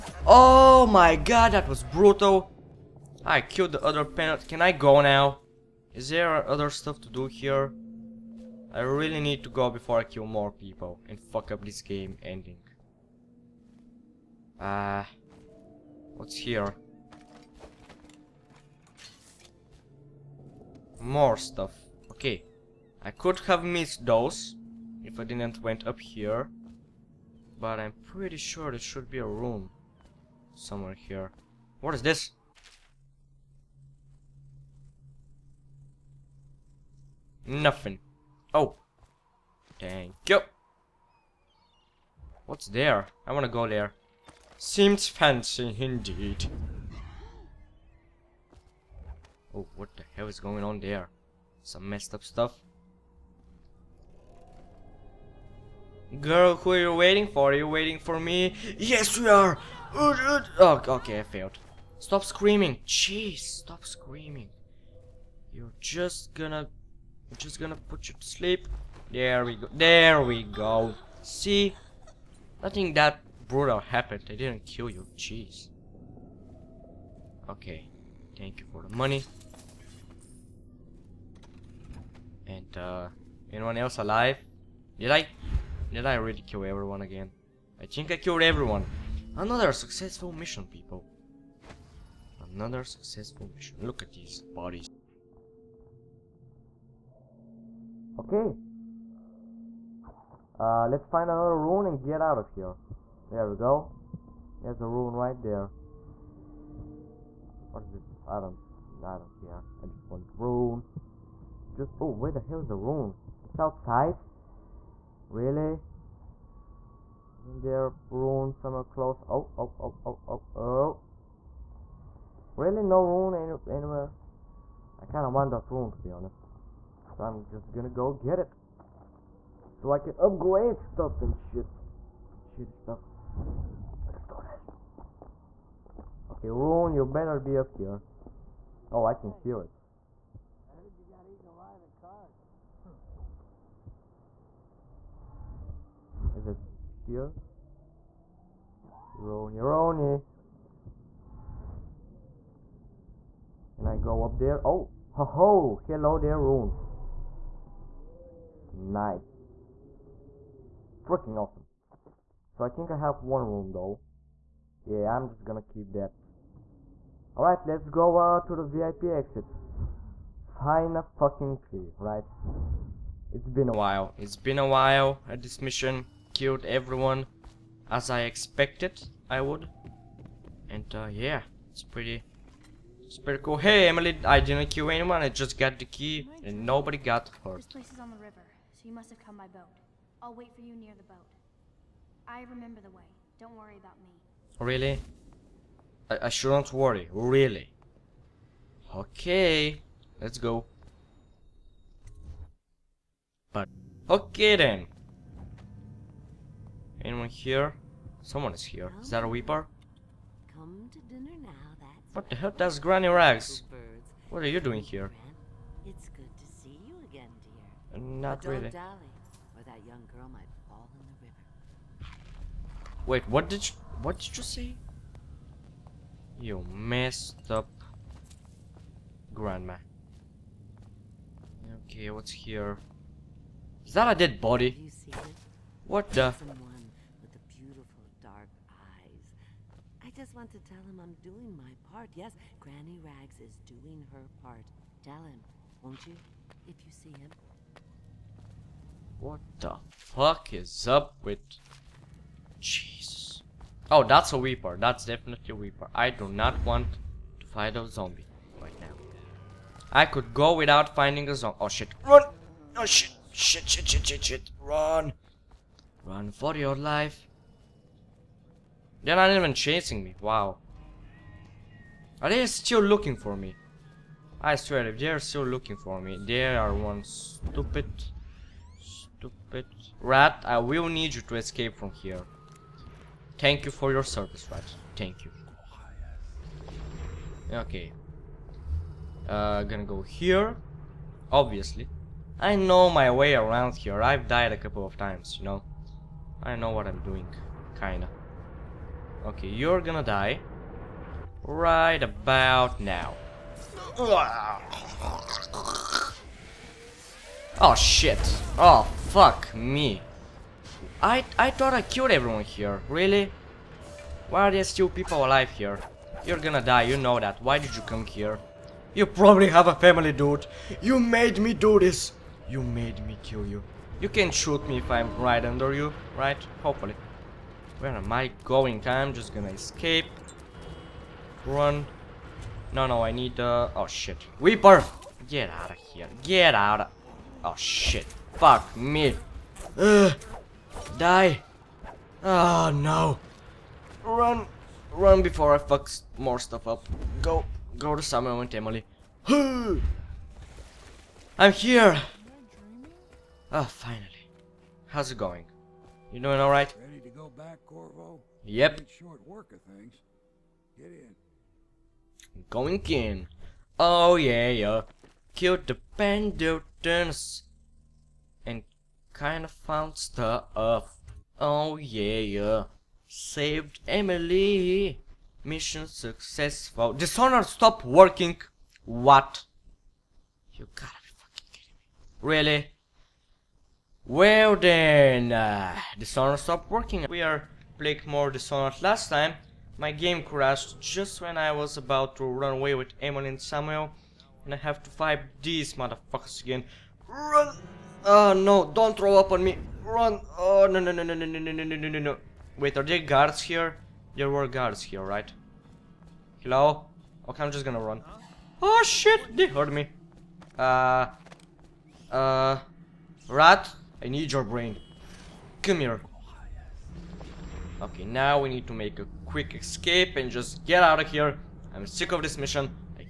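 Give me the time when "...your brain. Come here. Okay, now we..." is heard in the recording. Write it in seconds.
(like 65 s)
414 s.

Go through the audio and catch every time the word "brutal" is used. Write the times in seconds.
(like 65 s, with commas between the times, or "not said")
1 s, 73 s.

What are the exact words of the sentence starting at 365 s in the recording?
Killed the Pendletons and kind of found stuff.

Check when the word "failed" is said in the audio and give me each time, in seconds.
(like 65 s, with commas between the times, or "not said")
61 s.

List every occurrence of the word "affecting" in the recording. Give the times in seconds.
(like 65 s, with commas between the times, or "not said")
not said.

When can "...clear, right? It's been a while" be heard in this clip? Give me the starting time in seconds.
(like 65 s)
171 s.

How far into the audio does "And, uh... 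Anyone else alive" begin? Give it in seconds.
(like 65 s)
82 s.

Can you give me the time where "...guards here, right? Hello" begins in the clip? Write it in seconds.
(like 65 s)
404 s.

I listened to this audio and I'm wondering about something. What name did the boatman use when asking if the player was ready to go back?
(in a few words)
Corvo.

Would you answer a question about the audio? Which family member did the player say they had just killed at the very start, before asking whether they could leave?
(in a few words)
The other Pendleton.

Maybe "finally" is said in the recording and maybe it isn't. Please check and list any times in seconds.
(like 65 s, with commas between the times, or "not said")
353 s.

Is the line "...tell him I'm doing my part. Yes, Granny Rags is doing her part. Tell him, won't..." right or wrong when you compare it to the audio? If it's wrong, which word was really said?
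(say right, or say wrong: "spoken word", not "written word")
right.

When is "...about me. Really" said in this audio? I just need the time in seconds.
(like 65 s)
193 s.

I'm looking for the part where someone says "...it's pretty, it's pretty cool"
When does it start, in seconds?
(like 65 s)
181 s.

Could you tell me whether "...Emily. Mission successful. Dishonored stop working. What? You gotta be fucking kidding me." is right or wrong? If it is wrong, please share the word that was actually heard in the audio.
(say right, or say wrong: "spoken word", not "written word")
right.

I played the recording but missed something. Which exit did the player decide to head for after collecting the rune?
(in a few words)
VIP exit.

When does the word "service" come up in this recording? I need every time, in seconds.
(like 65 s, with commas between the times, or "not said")
284 s.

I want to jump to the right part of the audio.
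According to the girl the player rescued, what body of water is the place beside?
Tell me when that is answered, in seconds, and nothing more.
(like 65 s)
188 s.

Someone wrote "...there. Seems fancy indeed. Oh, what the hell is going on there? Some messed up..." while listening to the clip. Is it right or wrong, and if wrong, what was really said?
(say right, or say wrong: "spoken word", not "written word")
right.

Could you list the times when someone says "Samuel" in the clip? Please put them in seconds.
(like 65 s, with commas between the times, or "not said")
348 s, 393 s.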